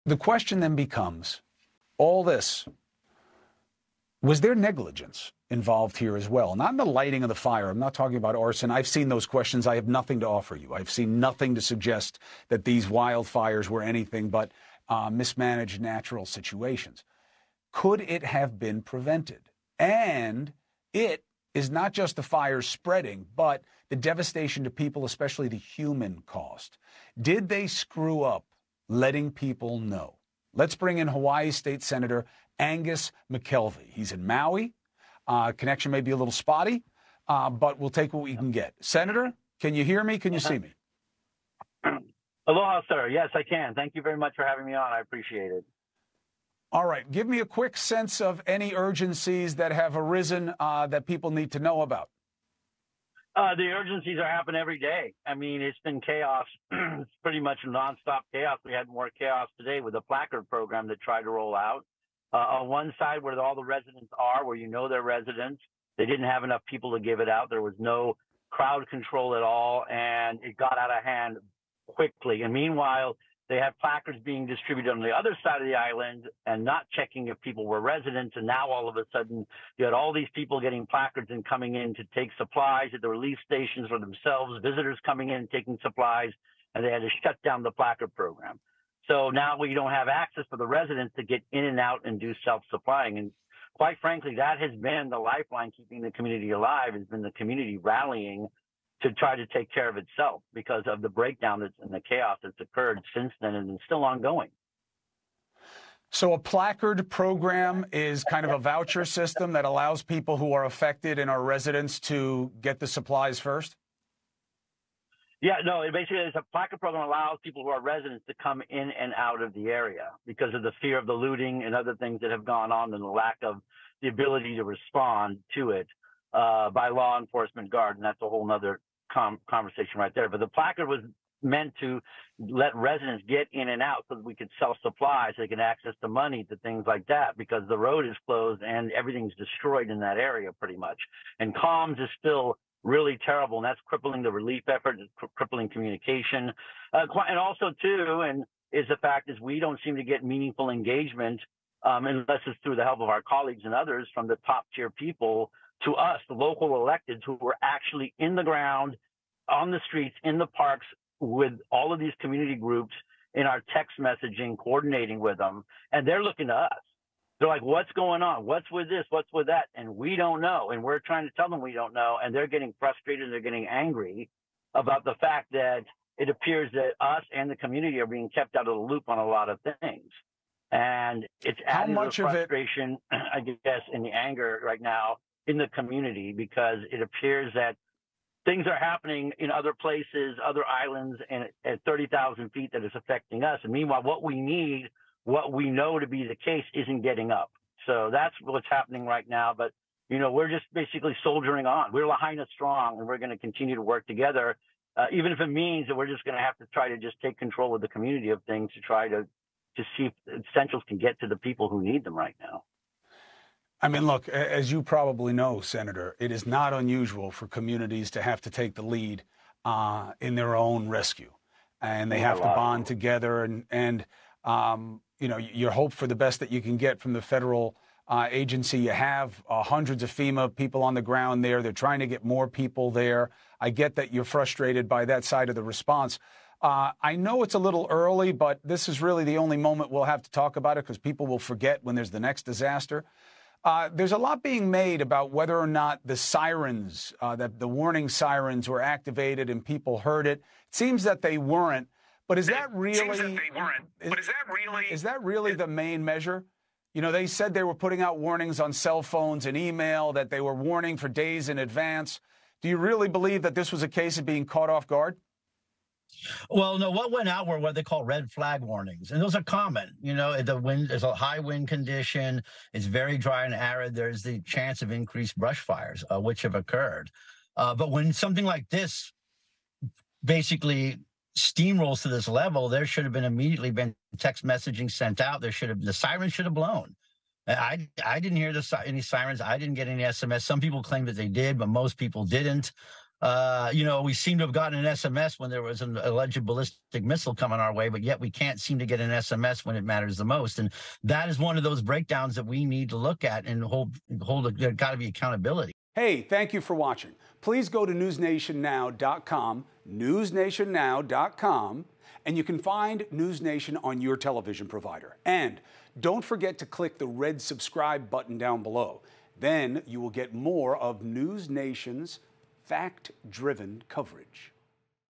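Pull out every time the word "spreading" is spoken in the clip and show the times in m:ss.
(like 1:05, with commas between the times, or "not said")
0:22.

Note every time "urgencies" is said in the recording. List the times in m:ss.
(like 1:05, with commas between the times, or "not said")
0:48, 0:53.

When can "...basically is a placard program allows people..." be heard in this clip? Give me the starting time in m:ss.
1:55.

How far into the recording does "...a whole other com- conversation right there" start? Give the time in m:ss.
2:08.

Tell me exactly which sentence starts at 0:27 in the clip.
Did they screw up letting people know.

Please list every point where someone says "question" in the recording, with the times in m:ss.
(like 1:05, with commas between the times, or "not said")
0:00, 0:09.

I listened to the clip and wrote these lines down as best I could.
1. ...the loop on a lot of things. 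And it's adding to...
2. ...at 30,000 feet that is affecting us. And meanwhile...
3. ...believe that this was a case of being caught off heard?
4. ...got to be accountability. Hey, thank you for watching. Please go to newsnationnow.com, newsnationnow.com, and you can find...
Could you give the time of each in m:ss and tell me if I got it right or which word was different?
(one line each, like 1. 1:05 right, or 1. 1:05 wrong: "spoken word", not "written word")
1. 2:58 right
2. 3:11 right
3. 4:23 wrong: "guard", not "heard"
4. 5:04 right.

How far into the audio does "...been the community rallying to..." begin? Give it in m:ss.
1:37.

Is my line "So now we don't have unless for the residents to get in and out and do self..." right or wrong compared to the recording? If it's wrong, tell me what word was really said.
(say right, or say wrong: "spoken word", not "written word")
wrong: "access", not "unless".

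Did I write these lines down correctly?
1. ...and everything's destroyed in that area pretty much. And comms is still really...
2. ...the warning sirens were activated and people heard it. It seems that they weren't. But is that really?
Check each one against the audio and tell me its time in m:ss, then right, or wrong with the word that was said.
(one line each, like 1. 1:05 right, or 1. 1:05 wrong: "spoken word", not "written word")
1. 2:18 right
2. 4:07 right.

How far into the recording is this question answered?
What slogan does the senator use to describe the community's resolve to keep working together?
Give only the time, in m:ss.
3:22.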